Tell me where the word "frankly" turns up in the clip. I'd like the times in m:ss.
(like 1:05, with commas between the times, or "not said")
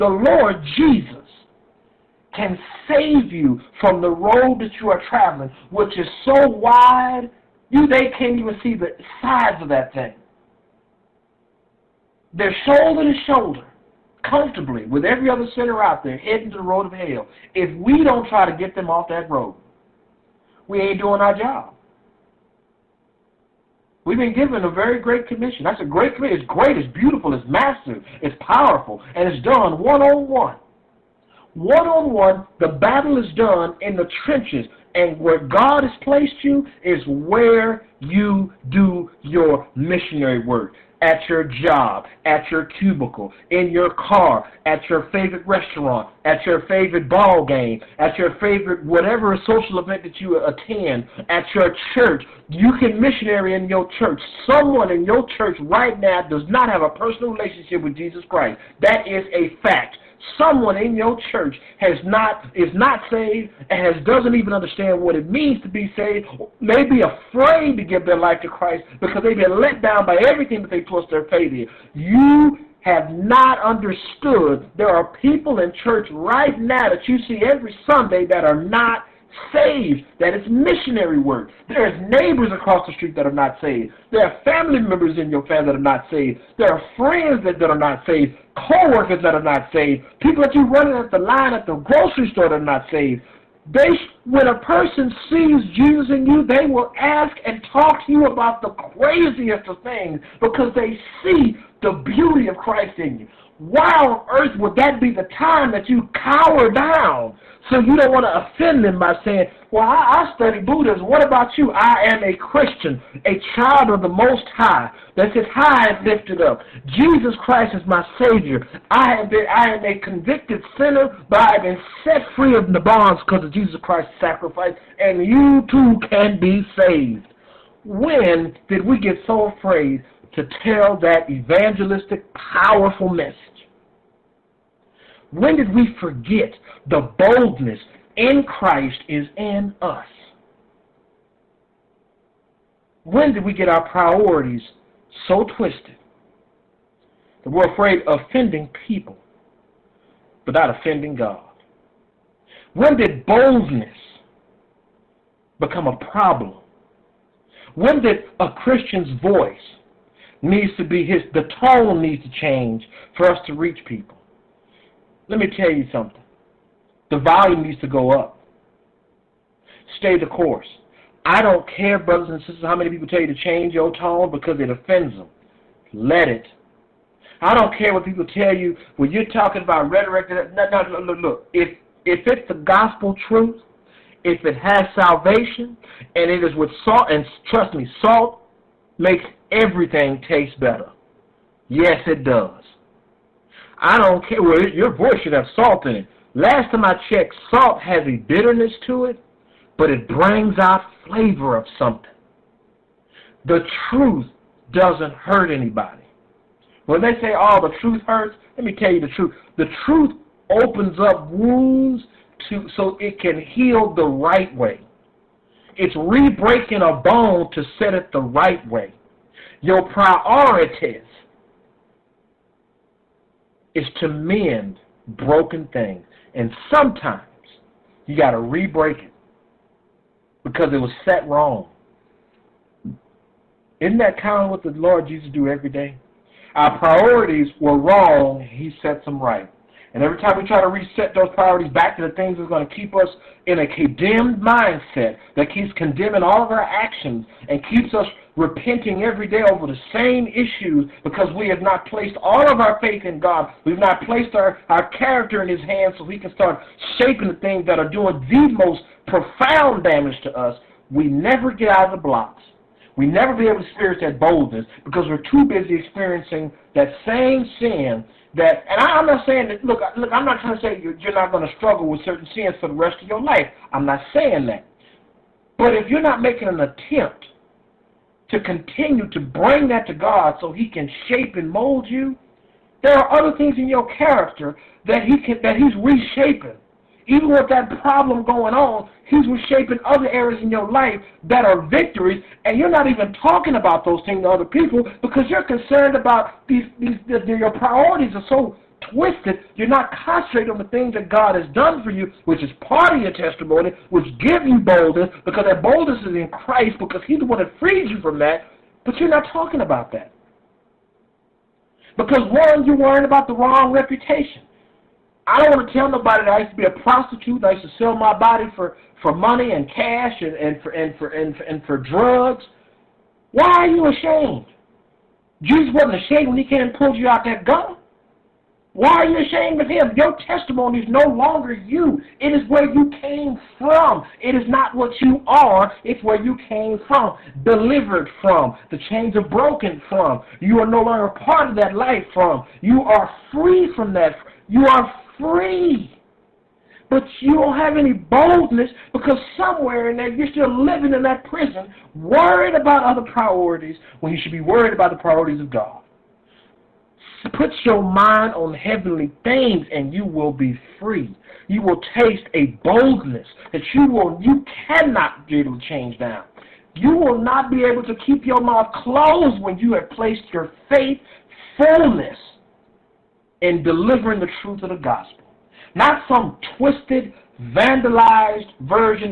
not said.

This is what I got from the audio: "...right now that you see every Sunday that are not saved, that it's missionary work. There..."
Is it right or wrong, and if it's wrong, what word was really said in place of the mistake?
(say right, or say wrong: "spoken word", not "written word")
right.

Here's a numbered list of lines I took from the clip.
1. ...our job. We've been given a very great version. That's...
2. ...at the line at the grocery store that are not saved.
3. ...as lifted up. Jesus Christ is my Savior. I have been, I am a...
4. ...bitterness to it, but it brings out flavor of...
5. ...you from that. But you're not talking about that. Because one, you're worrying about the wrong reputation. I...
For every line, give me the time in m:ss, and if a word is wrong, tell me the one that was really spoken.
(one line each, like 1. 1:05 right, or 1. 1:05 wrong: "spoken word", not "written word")
1. 0:21 wrong: "commission", not "version"
2. 1:30 right
3. 1:55 right
4. 3:18 right
5. 5:07 right.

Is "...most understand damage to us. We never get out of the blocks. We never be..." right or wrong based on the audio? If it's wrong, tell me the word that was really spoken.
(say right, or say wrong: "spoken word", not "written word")
wrong: "profound", not "understand".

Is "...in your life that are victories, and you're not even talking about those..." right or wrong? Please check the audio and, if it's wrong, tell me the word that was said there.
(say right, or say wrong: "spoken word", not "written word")
right.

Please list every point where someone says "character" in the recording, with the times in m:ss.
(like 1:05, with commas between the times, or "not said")
4:14, 4:43.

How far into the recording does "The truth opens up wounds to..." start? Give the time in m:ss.
3:29.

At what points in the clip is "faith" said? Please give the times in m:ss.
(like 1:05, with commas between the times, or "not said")
1:11, 4:12, 6:10.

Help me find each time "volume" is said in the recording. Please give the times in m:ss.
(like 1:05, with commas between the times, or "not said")
2:47.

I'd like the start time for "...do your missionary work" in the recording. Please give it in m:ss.
0:38.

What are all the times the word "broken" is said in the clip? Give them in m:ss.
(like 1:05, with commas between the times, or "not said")
3:45, 5:39.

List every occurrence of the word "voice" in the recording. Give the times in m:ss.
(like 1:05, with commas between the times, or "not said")
2:39, 3:14.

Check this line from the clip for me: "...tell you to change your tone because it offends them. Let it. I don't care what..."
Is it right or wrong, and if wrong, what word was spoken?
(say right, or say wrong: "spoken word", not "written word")
right.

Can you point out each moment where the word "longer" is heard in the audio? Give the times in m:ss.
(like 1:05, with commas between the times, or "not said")
5:31, 5:40.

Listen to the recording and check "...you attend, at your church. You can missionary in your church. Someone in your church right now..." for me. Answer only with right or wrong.
right.